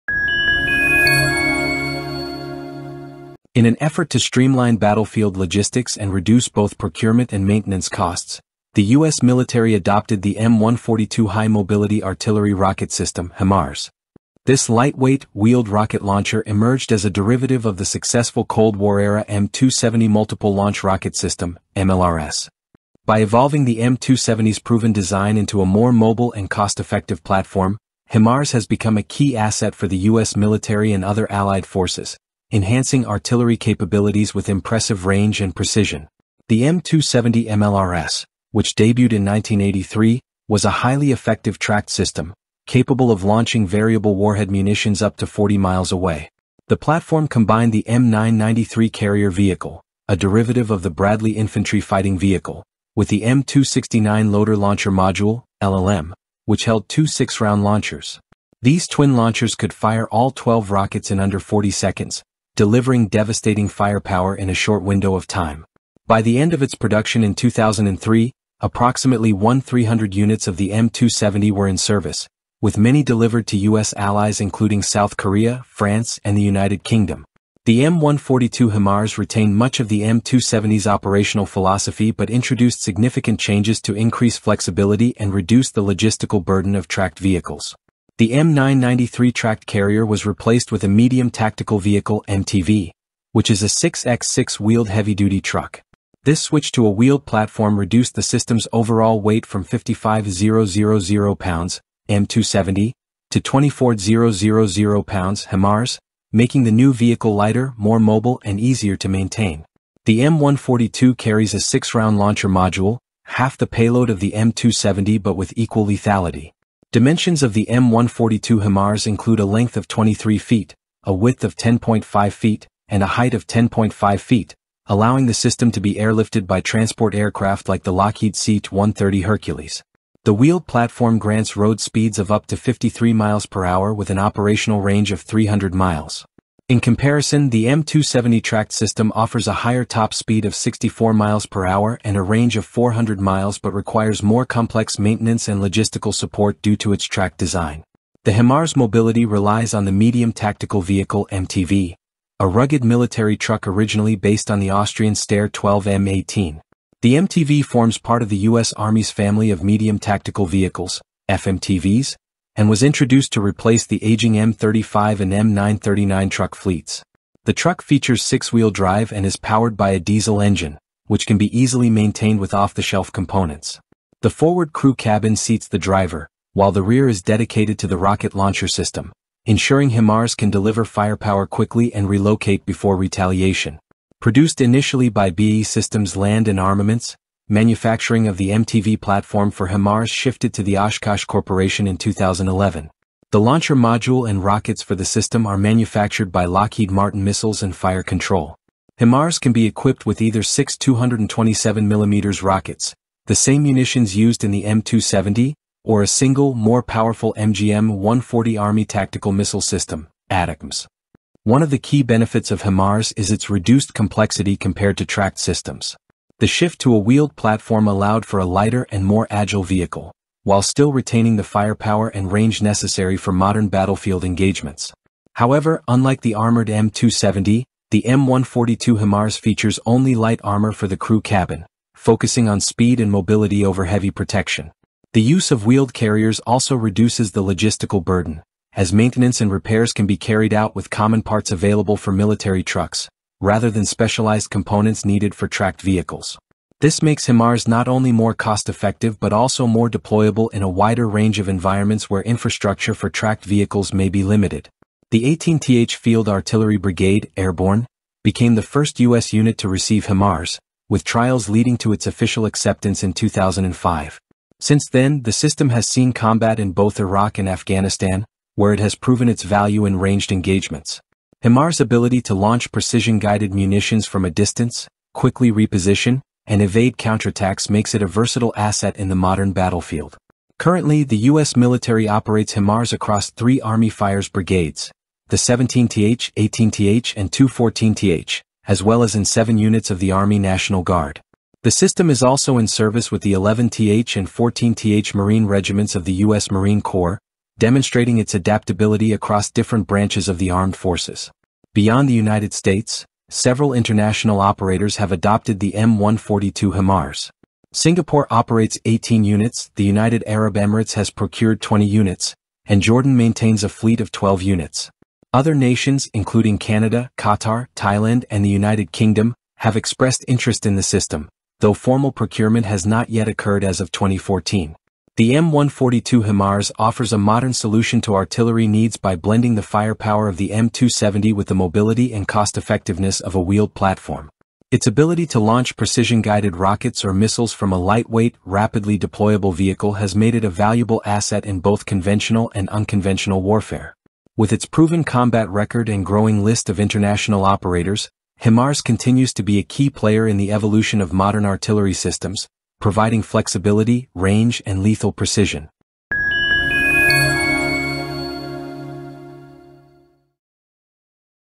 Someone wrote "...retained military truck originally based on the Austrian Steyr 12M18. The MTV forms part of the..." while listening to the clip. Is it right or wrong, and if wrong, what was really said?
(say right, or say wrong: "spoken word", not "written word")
wrong: "rugged", not "retained".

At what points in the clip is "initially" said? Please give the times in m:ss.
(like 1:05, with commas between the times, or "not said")
3:04.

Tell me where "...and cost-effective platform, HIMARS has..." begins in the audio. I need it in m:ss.
0:26.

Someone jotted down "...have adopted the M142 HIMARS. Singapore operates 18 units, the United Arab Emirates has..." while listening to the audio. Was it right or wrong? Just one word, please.
right.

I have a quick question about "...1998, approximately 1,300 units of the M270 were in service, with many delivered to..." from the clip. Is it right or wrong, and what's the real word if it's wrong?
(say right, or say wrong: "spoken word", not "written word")
wrong: "2003", not "1998".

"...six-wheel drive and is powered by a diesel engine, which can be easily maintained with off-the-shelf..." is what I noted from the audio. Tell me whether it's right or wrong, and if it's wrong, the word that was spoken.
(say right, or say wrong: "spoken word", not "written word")
right.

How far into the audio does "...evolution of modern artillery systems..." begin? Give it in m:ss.
5:50.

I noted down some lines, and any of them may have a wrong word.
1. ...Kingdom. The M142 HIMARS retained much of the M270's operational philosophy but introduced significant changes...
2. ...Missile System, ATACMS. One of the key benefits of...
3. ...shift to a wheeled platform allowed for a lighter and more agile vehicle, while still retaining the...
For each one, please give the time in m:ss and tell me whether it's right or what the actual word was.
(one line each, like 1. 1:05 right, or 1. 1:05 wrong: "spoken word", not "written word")
1. 1:16 right
2. 3:29 right
3. 3:36 right.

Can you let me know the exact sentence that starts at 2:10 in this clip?
The wheeled platform grants road speeds of up to 53 miles per hour with an operational range of 300 miles.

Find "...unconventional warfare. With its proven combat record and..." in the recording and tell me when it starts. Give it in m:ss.
5:42.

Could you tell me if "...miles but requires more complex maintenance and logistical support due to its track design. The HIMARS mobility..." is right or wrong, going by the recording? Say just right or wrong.
right.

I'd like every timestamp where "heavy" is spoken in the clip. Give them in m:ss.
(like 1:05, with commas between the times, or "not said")
1:34, 3:53.